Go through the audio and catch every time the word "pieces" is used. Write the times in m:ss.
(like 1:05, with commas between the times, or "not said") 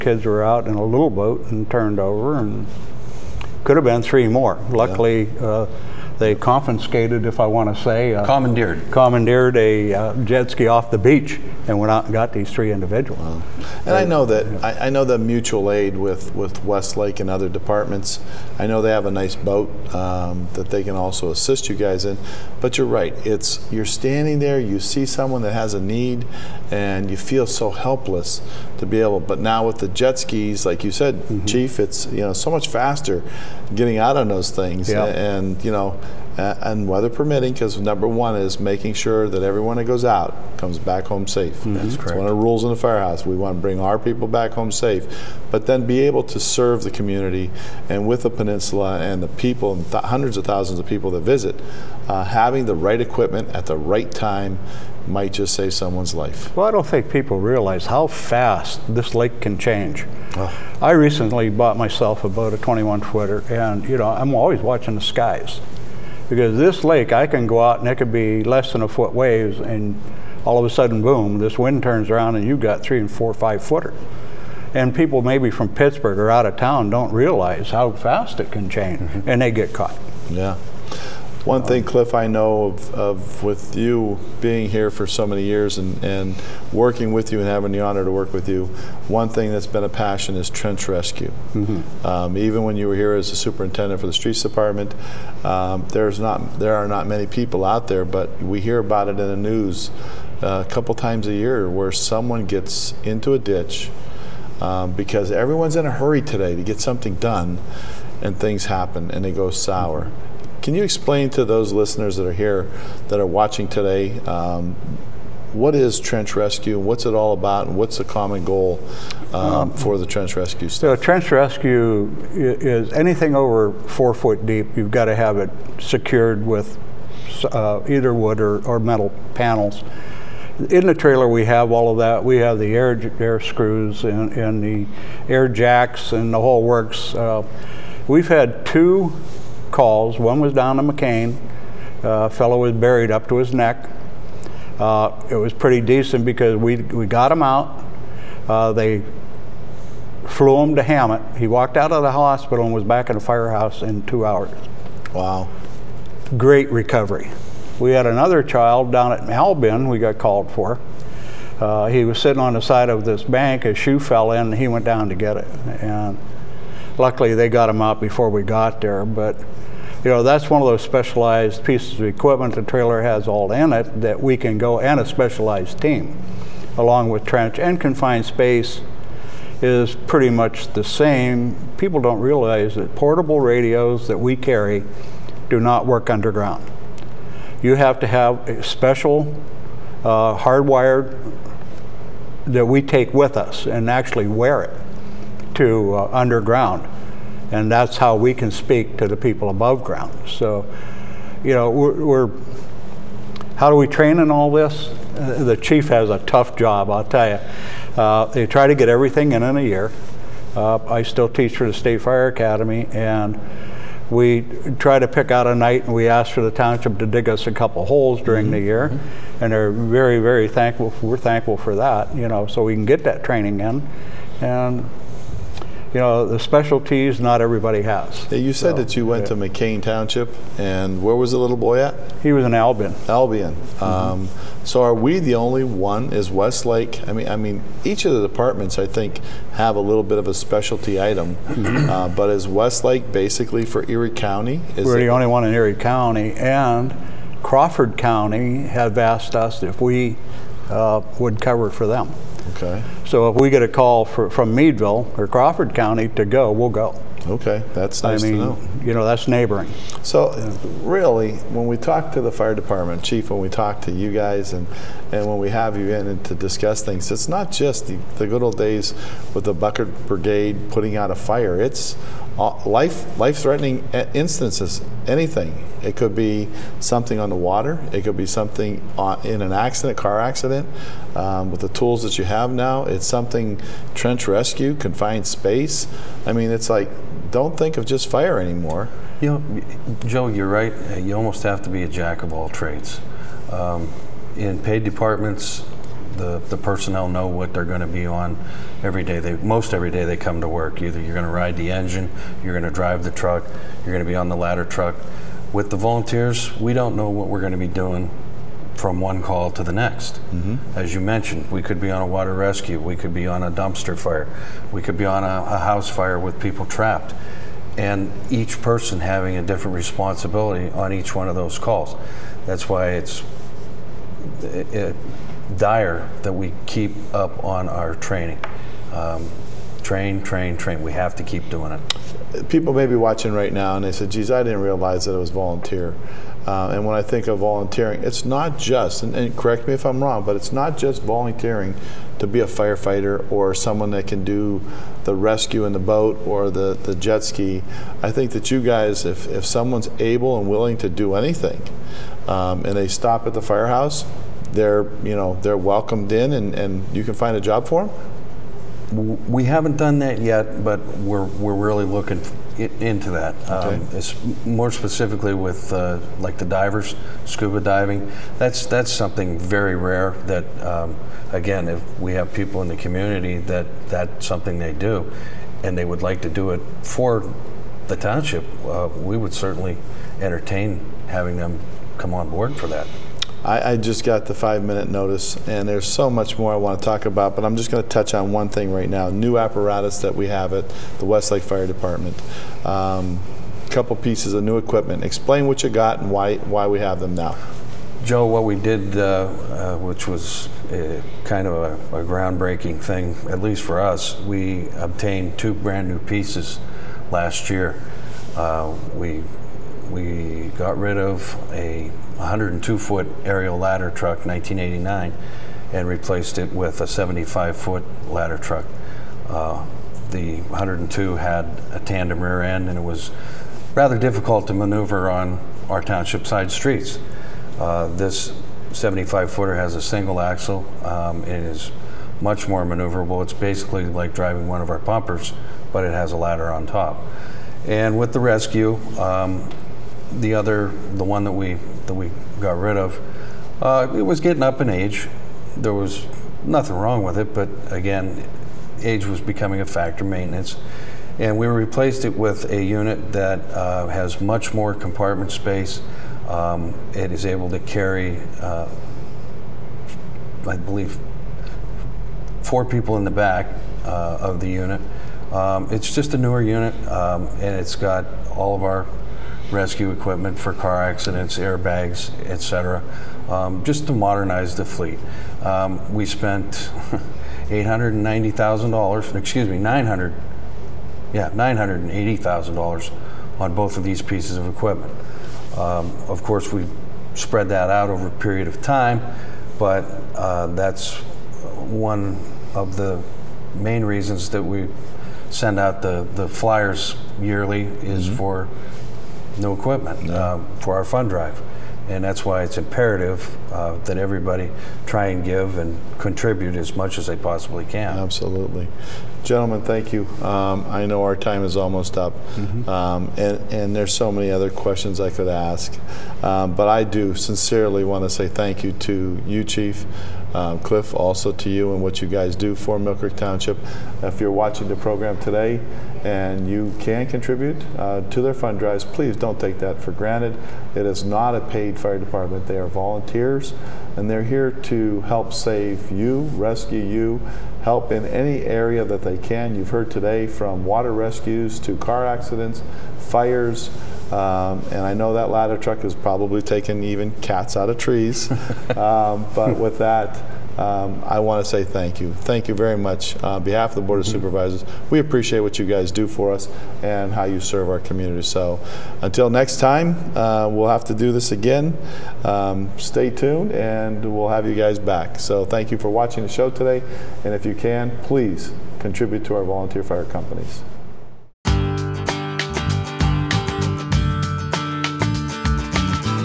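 2:51, 6:33, 6:46, 8:04.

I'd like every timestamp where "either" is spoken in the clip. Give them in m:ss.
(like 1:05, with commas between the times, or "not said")
2:07, 5:00.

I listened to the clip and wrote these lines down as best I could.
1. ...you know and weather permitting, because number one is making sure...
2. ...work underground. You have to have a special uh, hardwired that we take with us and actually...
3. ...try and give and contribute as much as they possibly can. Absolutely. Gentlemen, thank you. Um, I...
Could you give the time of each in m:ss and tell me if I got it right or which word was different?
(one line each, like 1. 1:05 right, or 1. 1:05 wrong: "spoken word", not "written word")
1. 0:35 right
2. 3:05 right
3. 8:24 right.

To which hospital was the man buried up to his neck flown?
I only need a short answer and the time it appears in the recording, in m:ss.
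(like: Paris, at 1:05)
Hamot, at 2:30.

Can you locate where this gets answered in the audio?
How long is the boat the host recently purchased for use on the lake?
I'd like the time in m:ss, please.
1:02.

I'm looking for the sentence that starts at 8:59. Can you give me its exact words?
You've heard today from water rescues to car accidents, fires.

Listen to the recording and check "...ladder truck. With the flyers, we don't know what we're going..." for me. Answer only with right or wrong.
wrong.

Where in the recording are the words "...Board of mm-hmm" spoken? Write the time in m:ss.
9:13.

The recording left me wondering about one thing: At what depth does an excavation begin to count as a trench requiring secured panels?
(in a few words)
four foot.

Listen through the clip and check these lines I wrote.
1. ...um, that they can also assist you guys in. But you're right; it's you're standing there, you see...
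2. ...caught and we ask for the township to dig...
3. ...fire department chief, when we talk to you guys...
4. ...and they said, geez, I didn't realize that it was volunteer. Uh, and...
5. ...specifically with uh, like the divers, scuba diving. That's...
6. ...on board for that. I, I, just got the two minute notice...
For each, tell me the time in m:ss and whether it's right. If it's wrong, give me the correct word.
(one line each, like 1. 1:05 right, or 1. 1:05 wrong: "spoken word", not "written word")
1. 0:19 right
2. 3:35 wrong: "night", not "caught"
3. 4:22 right
4. 5:33 right
5. 6:04 right
6. 6:22 wrong: "five", not "two".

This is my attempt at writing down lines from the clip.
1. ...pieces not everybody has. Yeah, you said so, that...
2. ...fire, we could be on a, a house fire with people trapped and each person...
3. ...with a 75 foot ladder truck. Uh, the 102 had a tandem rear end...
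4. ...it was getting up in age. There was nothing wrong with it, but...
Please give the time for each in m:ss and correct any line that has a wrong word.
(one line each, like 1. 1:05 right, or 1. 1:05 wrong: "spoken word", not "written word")
1. 3:46 wrong: "specialties", not "pieces"
2. 5:13 right
3. 6:56 right
4. 7:23 right.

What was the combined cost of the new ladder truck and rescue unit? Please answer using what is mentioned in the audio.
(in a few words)
$980,000.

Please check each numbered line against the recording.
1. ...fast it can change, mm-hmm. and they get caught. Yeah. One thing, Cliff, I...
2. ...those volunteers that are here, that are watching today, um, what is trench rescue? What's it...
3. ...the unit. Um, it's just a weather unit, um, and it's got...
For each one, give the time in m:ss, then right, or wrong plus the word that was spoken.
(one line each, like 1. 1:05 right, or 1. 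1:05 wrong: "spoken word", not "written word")
1. 1:17 right
2. 1:51 wrong: "listeners", not "volunteers"
3. 7:44 wrong: "newer", not "weather".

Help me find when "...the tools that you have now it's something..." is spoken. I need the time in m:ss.
4:41.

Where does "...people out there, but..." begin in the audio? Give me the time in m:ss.
1:37.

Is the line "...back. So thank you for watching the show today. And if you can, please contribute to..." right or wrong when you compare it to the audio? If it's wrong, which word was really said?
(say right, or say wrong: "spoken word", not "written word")
right.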